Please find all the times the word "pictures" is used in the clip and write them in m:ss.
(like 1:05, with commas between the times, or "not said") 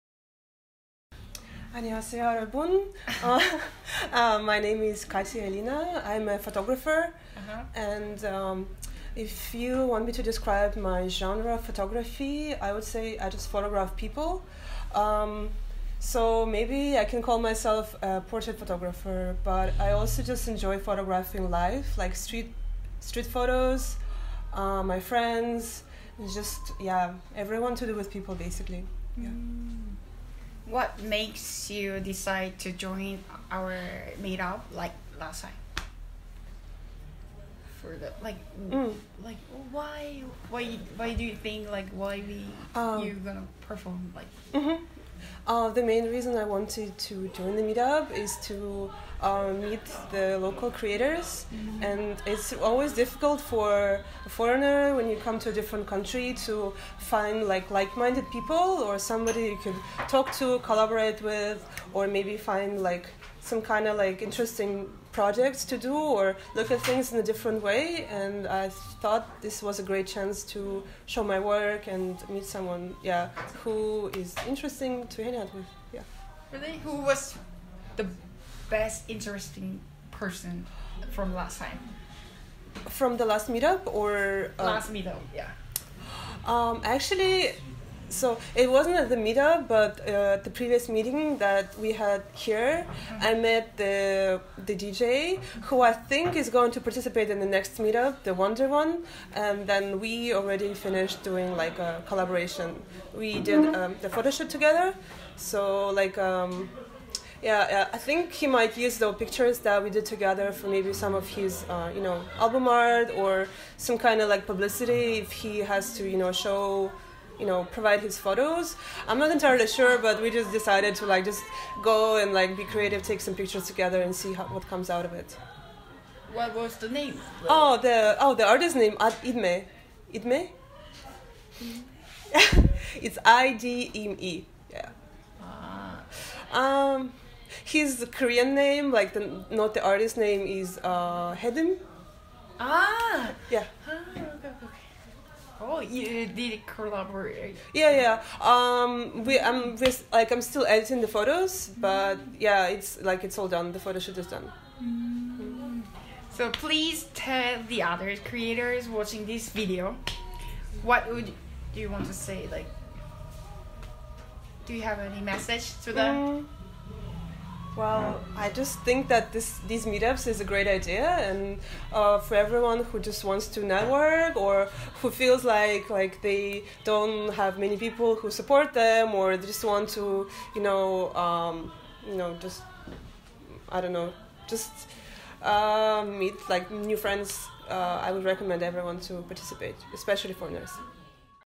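1:49, 2:03.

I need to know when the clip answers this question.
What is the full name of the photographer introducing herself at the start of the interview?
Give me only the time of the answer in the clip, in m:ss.
0:05.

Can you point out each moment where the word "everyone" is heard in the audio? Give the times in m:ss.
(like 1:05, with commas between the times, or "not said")
0:27, 2:52, 3:08.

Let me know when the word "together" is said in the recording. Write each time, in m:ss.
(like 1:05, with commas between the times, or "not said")
1:44, 1:50, 2:03.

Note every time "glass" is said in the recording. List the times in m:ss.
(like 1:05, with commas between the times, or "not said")
not said.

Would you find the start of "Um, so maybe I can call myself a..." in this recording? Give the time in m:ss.
0:14.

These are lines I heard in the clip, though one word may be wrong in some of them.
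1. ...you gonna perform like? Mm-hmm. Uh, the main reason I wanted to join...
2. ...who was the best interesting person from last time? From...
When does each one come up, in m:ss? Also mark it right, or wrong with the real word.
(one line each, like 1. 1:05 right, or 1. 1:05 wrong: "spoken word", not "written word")
1. 0:43 right
2. 1:16 right.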